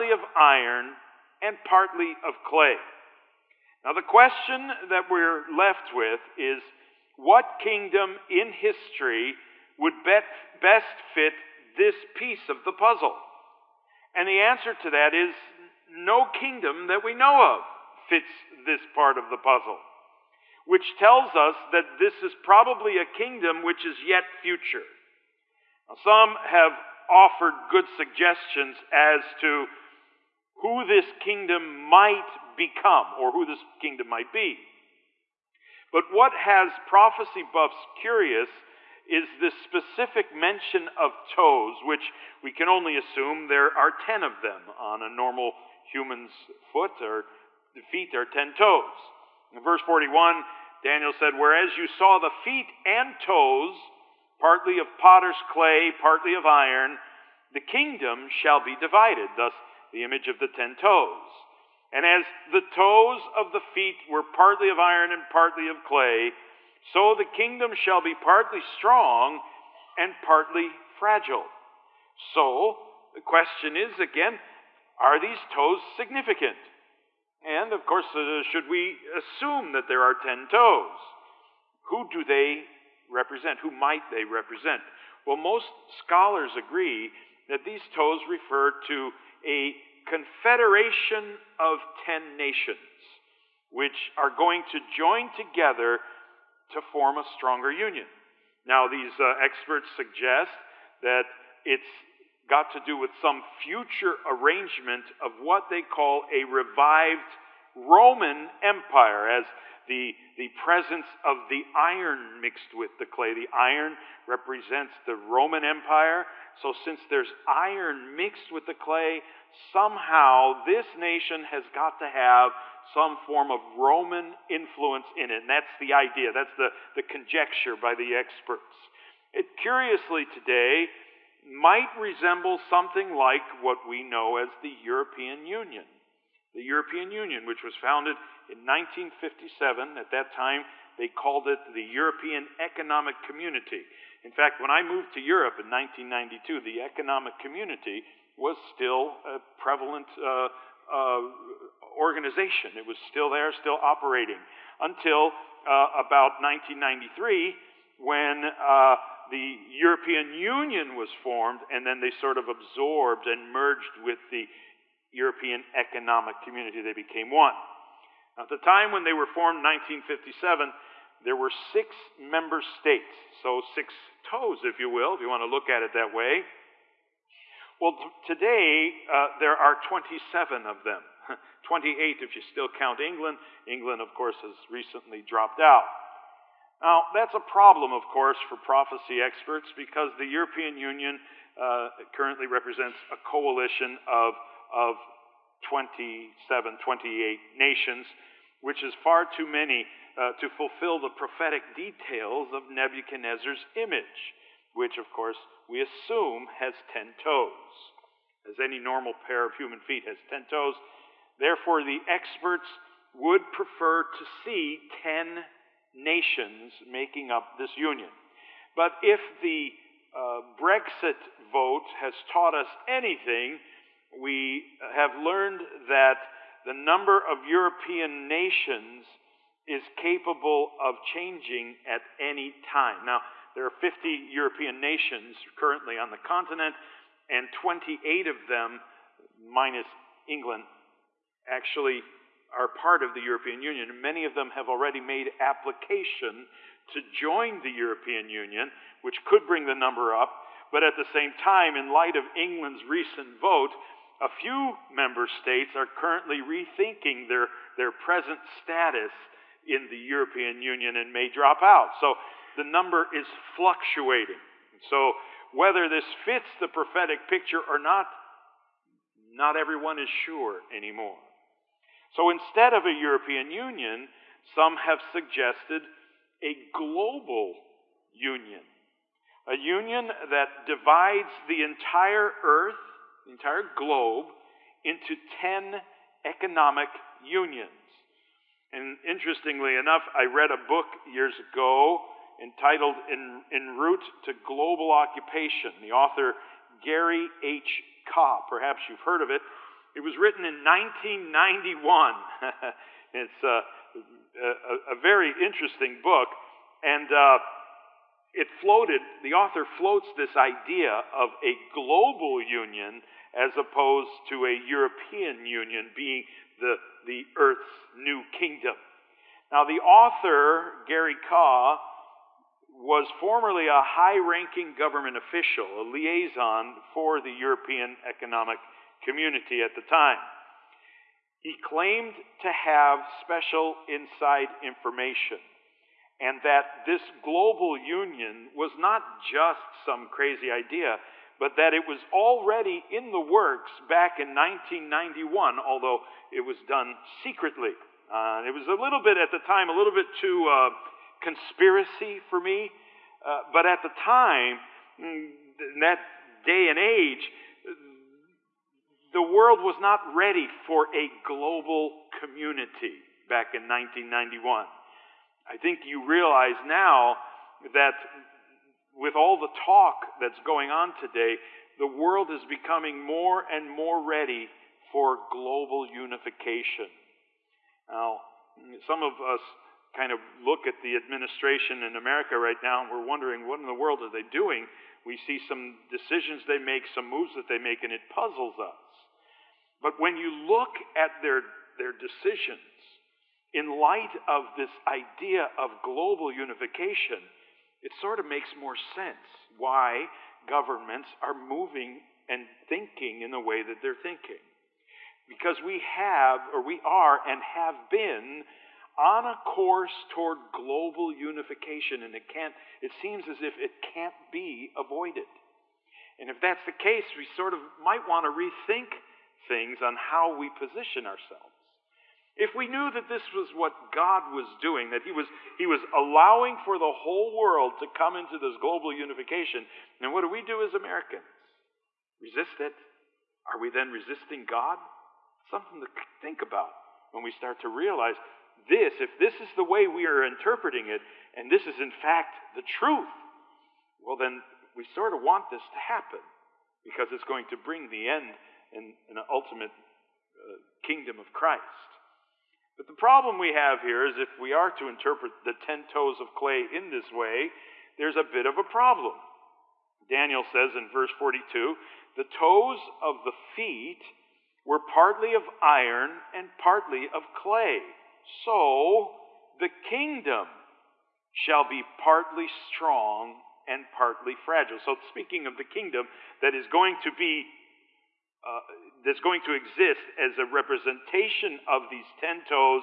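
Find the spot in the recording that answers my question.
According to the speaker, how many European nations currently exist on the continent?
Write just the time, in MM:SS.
03:53.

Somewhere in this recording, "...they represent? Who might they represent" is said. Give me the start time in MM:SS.
01:22.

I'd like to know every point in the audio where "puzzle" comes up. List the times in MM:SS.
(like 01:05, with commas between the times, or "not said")
00:12, 00:19, 06:28.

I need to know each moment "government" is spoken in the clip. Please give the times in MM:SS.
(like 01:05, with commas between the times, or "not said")
05:24, 06:40.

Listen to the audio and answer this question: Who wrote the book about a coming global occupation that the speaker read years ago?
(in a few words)
Gary H. Kah.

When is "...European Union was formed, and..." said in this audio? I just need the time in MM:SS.
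02:39.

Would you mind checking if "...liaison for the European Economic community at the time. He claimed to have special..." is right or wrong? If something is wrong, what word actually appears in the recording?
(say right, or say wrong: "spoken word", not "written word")
right.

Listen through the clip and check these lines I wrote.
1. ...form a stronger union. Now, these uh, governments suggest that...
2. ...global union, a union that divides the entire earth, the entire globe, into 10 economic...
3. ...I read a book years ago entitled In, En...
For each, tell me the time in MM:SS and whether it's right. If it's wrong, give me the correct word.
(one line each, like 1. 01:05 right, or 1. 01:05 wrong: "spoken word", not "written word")
1. 01:36 wrong: "experts", not "governments"
2. 04:36 right
3. 04:50 right.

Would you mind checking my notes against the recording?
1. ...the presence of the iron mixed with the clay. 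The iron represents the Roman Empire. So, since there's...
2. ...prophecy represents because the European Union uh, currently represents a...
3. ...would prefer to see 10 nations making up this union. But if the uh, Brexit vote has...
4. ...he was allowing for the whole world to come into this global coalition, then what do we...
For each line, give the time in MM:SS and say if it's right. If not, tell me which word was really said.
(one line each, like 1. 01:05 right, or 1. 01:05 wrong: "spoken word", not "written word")
1. 01:50 right
2. 03:08 wrong: "experts", not "represents"
3. 03:33 right
4. 07:05 wrong: "unification", not "coalition".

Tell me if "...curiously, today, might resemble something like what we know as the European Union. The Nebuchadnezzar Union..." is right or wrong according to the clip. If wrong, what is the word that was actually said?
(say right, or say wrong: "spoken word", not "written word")
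wrong: "European", not "Nebuchadnezzar".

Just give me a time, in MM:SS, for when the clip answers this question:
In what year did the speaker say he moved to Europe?
02:25.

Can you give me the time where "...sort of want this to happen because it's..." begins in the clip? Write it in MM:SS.
07:24.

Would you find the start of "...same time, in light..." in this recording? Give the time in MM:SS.
04:11.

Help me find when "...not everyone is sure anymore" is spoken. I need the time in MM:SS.
04:29.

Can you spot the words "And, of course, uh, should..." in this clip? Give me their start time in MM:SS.
01:17.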